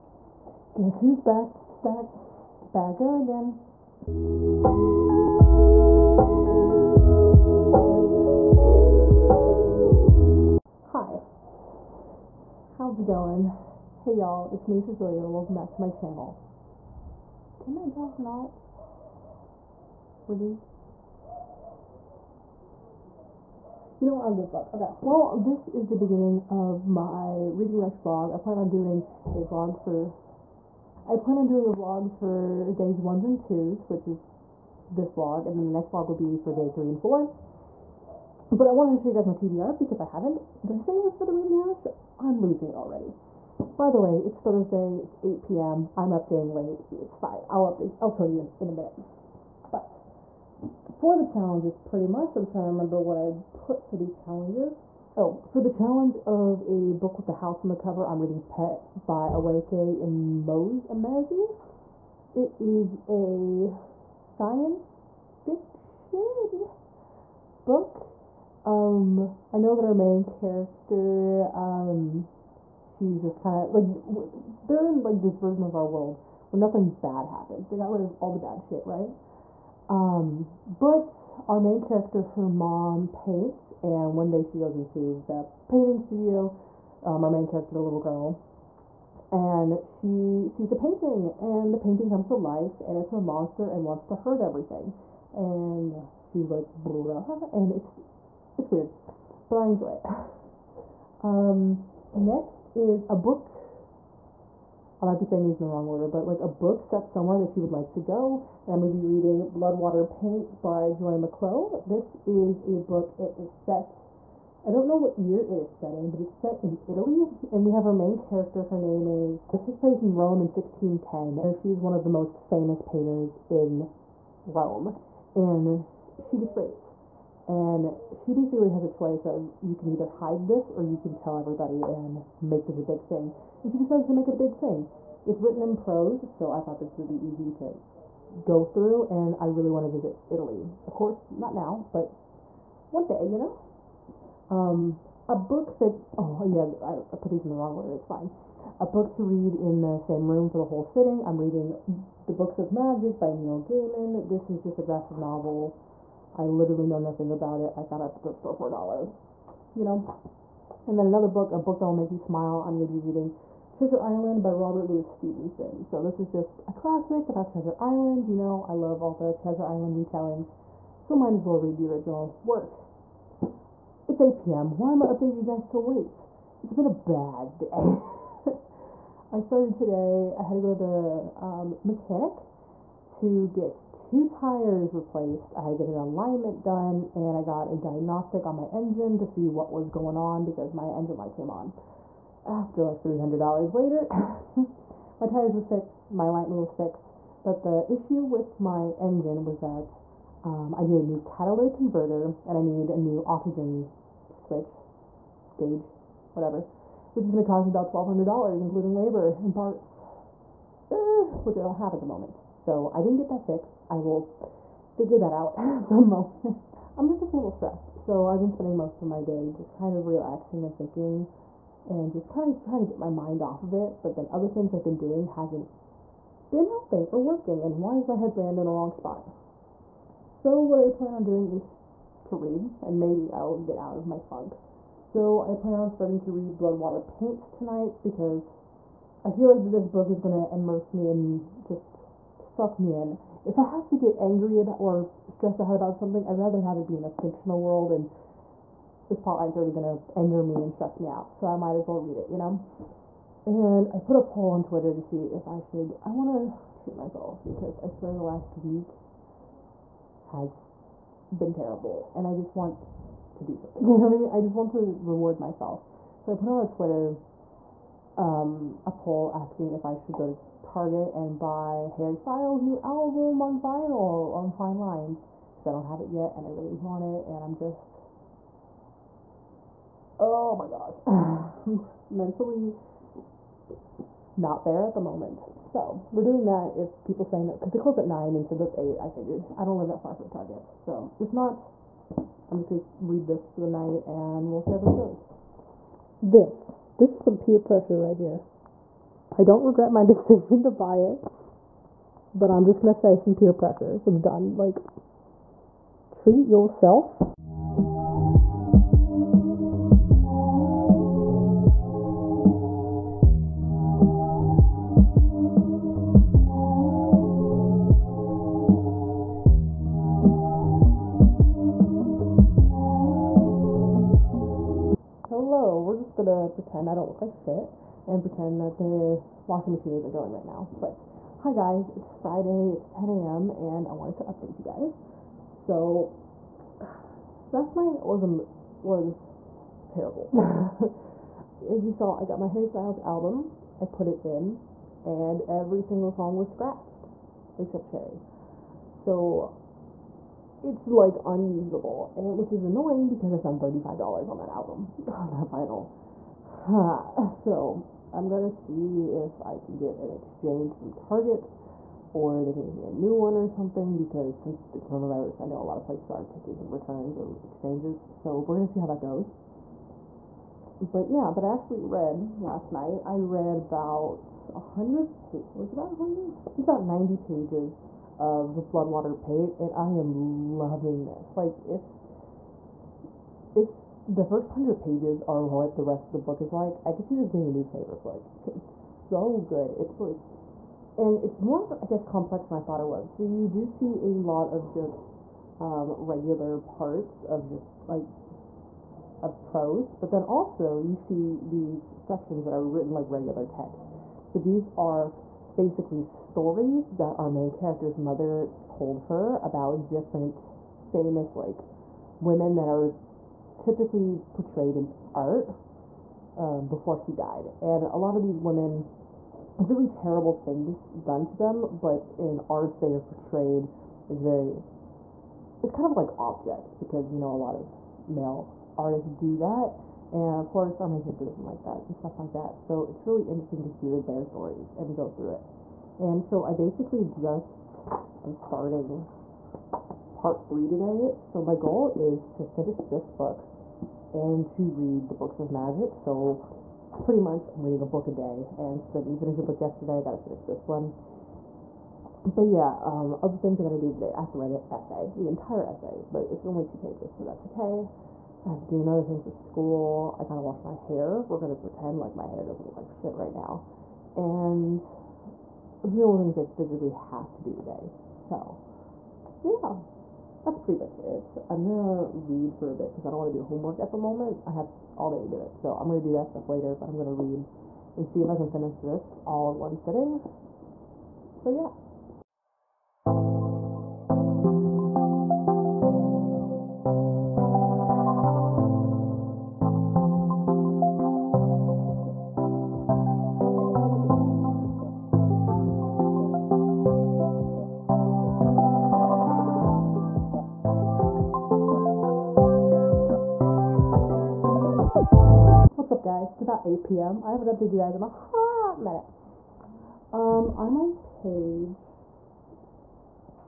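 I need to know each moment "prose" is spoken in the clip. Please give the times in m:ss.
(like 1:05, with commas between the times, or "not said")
2:15, 6:39.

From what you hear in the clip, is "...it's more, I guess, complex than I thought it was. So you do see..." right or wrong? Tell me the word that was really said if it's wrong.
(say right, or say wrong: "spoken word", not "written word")
right.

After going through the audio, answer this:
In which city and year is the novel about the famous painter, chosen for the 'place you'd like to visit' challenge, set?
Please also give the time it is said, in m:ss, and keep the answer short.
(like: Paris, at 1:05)
Rome, 1610, at 2:00.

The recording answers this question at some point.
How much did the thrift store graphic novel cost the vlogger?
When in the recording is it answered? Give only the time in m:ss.
2:38.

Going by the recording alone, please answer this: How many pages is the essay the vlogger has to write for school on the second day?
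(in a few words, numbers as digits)
2.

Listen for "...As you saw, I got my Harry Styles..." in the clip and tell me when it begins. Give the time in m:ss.
5:41.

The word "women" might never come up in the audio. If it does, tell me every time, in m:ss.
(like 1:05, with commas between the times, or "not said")
6:52, 6:58.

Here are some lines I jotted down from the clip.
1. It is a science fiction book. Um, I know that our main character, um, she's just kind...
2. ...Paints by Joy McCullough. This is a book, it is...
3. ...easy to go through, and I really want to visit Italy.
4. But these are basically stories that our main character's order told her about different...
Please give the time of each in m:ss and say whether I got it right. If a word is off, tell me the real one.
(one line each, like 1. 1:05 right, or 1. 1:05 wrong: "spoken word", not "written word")
1. 1:02 right
2. 1:50 right
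3. 2:17 right
4. 6:44 wrong: "mother", not "order".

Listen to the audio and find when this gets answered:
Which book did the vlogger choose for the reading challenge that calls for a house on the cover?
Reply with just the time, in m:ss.
0:58.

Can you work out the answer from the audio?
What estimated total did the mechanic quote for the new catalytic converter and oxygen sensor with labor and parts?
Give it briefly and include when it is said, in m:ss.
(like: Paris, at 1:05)
$1,200, at 3:27.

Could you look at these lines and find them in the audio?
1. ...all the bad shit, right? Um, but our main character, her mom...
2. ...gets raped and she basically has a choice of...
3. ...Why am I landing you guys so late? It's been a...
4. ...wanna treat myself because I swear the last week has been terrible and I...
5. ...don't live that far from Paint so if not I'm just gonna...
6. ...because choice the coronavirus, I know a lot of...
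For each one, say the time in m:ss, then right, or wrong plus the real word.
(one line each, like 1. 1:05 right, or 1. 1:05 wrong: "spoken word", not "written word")
1. 1:18 right
2. 2:06 right
3. 2:54 wrong: "updating", not "landing"
4. 4:16 right
5. 4:49 wrong: "Target", not "Paint"
6. 6:03 wrong: "since", not "choice".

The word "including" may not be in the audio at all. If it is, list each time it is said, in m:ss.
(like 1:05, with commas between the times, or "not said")
3:28.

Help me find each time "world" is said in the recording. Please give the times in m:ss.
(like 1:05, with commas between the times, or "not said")
1:15, 4:07.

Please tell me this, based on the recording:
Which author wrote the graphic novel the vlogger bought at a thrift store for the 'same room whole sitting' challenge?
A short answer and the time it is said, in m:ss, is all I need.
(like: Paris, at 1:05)
Neil Gaiman, at 2:33.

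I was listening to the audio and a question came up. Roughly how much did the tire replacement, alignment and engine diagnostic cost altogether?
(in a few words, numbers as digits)
$300.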